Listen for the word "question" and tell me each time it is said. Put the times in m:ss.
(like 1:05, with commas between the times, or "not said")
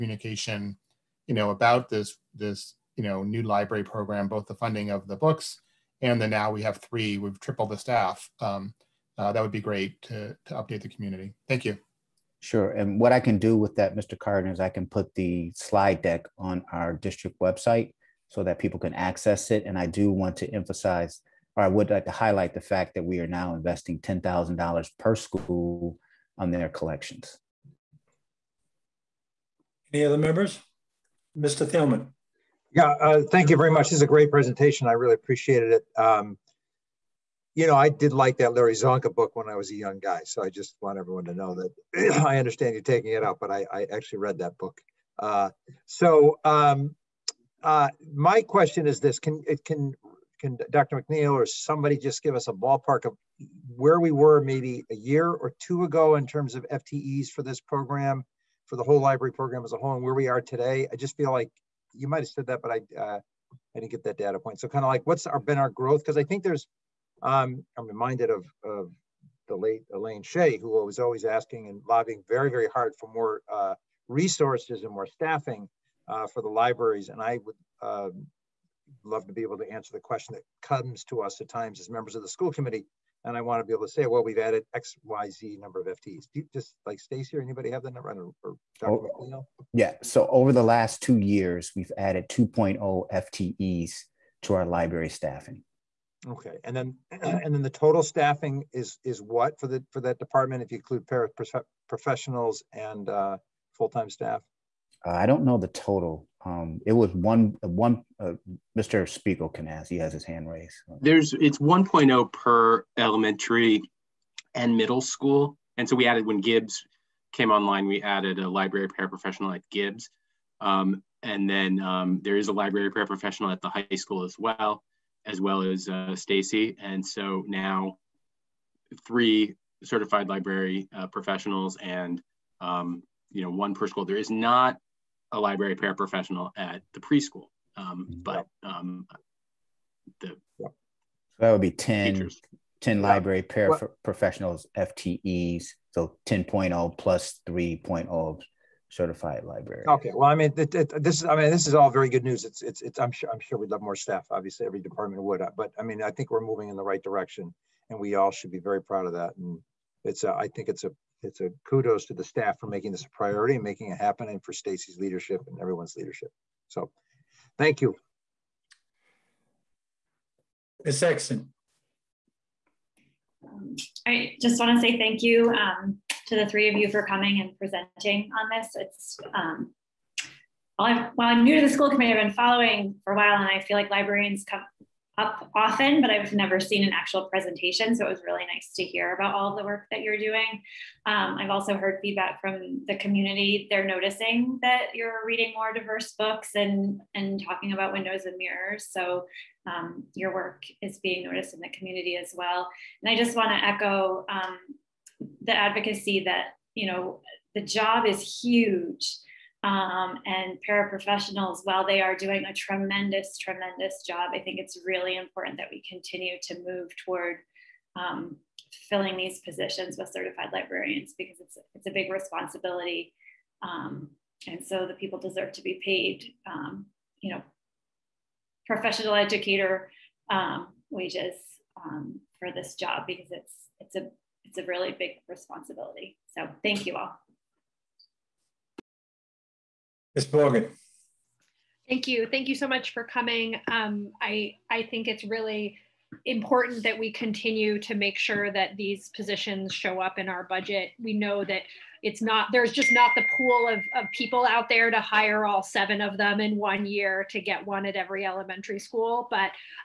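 0:48, 1:19.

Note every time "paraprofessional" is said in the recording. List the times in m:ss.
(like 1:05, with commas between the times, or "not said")
1:58, 2:02, 2:15, 2:23, 3:30.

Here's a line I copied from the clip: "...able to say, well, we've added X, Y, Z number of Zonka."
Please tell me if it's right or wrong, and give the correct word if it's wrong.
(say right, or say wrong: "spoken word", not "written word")
wrong: "FTEs", not "Zonka".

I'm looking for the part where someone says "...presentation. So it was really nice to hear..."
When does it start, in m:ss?
3:07.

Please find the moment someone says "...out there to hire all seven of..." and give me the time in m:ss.
4:14.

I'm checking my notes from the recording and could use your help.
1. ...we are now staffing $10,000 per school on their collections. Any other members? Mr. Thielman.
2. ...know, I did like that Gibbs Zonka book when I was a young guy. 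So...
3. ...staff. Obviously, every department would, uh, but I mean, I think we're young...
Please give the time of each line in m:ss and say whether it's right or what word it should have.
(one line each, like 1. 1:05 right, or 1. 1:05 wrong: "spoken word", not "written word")
1. 0:23 wrong: "investing", not "staffing"
2. 0:37 wrong: "Larry", not "Gibbs"
3. 2:33 wrong: "moving", not "young".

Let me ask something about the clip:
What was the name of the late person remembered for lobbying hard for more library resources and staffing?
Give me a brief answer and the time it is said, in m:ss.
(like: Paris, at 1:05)
Elaine Shea, at 1:09.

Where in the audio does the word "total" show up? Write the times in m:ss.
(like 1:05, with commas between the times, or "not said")
1:37, 1:45.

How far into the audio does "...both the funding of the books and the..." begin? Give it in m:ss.
0:04.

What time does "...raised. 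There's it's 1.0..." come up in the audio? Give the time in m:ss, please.
1:50.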